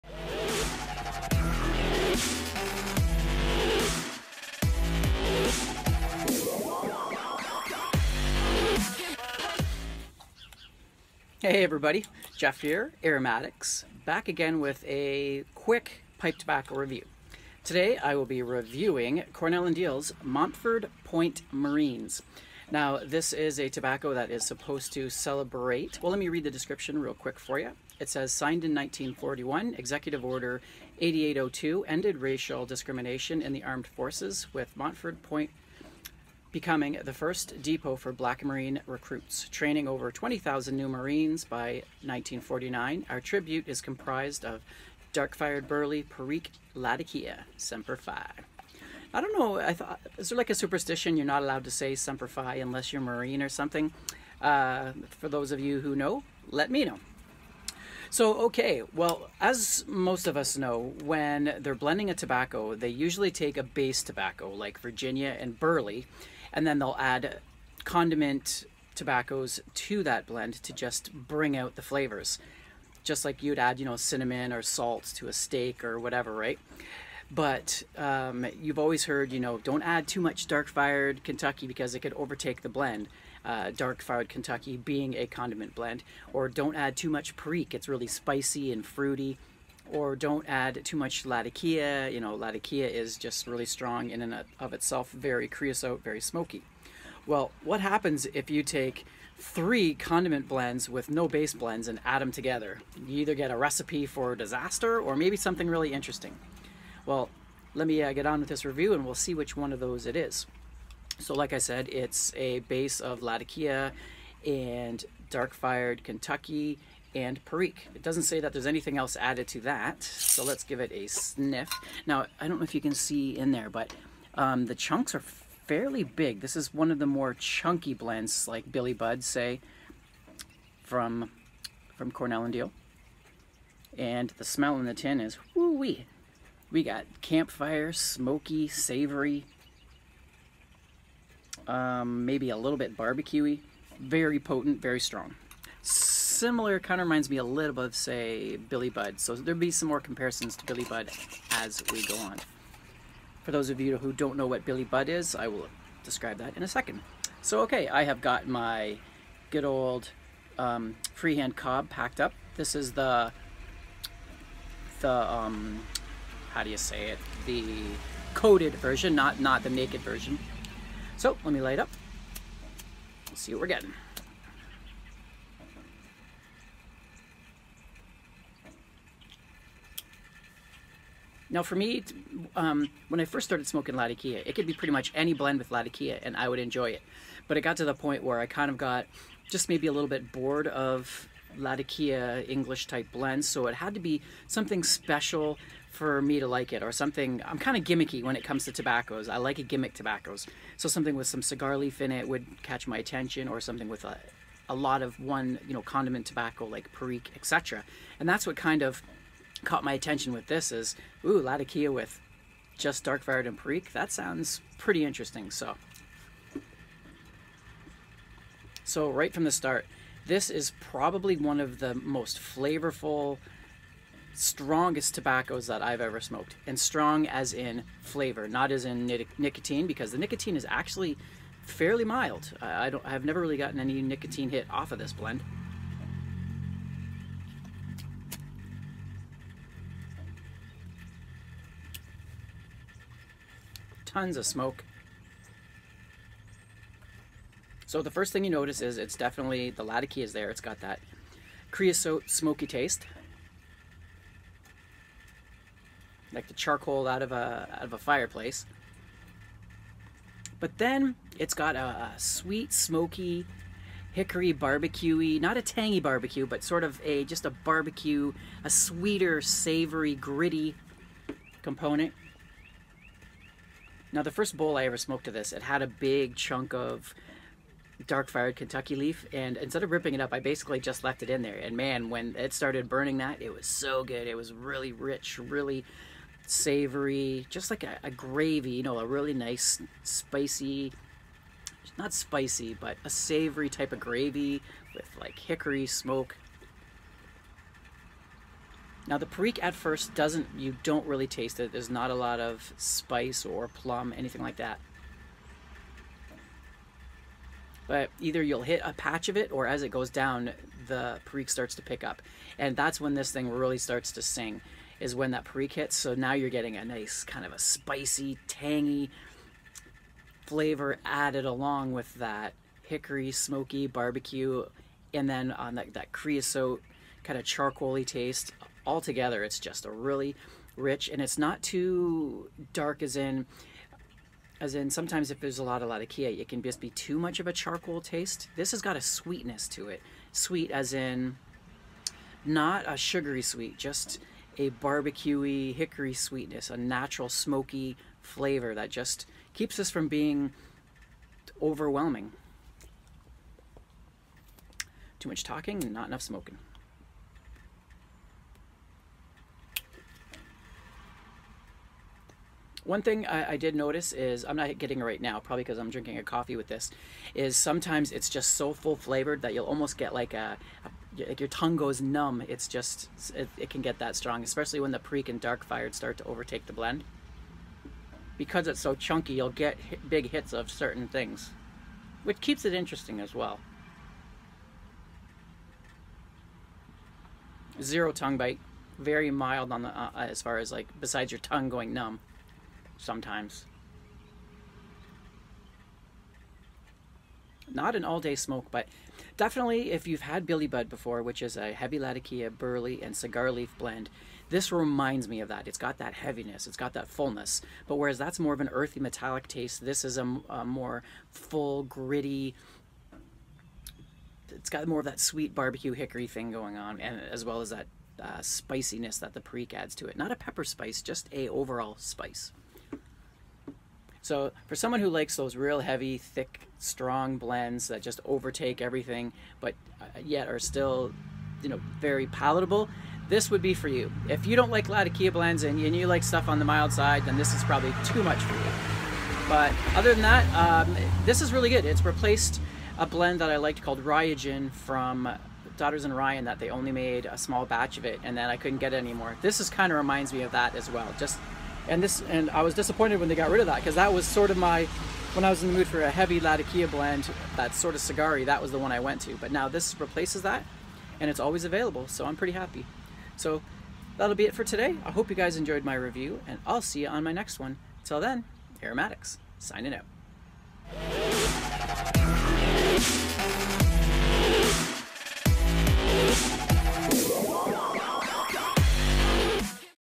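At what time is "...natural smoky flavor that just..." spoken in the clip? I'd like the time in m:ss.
5:46.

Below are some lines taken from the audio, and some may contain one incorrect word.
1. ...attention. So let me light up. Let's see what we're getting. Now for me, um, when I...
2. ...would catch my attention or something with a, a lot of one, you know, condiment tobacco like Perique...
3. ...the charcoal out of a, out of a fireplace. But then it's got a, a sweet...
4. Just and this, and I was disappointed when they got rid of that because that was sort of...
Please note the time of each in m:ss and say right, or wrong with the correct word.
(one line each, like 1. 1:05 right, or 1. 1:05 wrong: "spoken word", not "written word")
1. 2:50 wrong: "version", not "attention"
2. 3:22 right
3. 4:16 right
4. 7:31 right.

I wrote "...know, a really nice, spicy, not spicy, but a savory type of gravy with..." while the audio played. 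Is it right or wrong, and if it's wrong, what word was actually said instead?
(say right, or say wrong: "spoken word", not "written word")
right.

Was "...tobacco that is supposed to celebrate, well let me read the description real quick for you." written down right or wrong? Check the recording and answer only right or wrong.
right.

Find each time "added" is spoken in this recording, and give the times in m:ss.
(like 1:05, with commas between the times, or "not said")
1:59, 5:21.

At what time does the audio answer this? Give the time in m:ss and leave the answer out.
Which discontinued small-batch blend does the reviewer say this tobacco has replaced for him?
7:24.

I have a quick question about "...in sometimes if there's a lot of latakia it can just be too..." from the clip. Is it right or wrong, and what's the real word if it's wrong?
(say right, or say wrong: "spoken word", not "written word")
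right.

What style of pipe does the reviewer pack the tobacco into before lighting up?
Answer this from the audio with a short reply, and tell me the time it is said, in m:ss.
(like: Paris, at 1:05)
freehand cob, at 2:41.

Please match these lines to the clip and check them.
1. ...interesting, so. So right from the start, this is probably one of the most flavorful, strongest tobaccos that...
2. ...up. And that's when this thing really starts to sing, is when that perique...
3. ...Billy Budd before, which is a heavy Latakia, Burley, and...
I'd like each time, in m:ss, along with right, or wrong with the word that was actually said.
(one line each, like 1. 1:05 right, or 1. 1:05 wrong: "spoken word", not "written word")
1. 3:35 right
2. 5:12 right
3. 6:40 right.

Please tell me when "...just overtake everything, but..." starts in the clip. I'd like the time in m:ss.
7:08.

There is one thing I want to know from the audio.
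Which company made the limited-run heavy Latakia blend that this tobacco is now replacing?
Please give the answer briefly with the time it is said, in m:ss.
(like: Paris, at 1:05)
Daughters and Ryan, at 7:25.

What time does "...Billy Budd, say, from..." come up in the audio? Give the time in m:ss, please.
2:08.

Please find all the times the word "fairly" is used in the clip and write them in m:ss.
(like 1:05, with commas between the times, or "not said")
2:05, 3:51.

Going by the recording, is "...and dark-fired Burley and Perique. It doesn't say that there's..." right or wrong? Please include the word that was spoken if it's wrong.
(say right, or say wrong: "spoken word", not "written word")
wrong: "Kentucky", not "Burley".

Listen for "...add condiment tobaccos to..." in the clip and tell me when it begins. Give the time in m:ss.
1:06.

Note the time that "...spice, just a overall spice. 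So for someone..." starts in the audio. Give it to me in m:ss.
7:00.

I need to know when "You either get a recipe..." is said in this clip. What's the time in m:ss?
1:43.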